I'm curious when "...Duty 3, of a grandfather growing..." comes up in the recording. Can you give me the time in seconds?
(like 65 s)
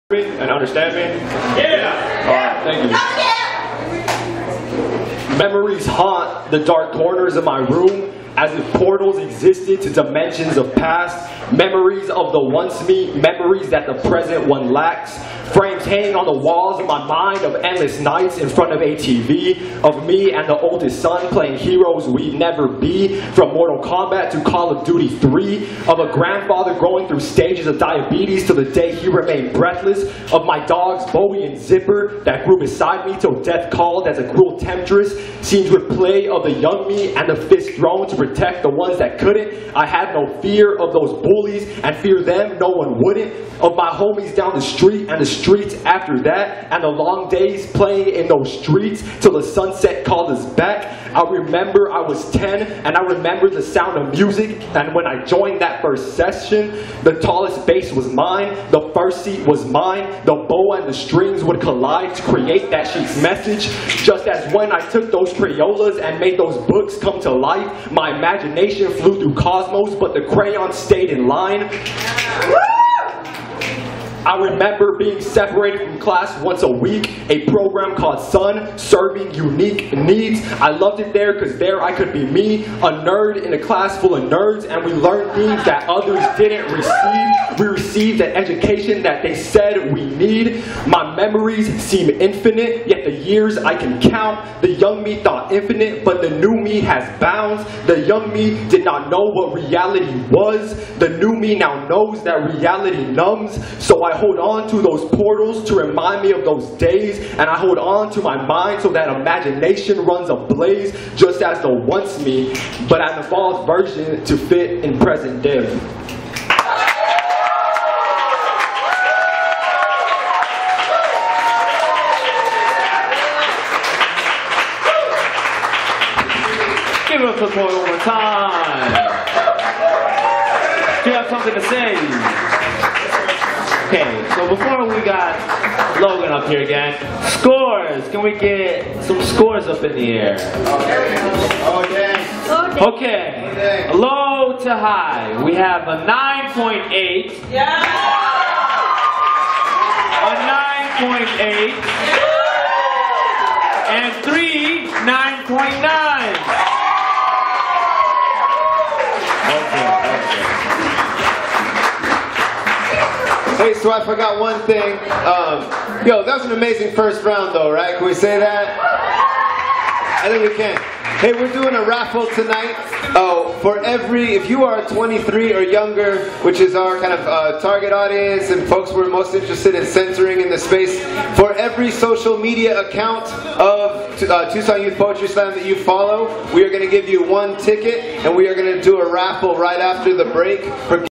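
24 s.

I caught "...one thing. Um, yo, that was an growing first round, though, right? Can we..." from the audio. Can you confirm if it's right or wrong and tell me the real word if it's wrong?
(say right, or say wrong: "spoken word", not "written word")
wrong: "amazing", not "growing".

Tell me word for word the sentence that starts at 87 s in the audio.
We received the education that they said we need.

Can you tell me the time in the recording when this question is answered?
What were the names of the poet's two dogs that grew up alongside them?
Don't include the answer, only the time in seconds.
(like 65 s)
31 s.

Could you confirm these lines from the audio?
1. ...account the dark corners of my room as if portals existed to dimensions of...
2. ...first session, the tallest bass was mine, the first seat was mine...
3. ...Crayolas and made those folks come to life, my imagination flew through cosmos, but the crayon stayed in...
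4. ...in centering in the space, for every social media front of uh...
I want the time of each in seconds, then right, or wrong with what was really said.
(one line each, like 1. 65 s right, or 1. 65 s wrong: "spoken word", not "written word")
1. 5 s wrong: "haunt", not "account"
2. 55 s right
3. 65 s wrong: "books", not "folks"
4. 179 s wrong: "account", not "front".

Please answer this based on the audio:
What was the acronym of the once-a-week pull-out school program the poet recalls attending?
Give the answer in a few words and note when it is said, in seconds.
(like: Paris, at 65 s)
Sun, at 78 s.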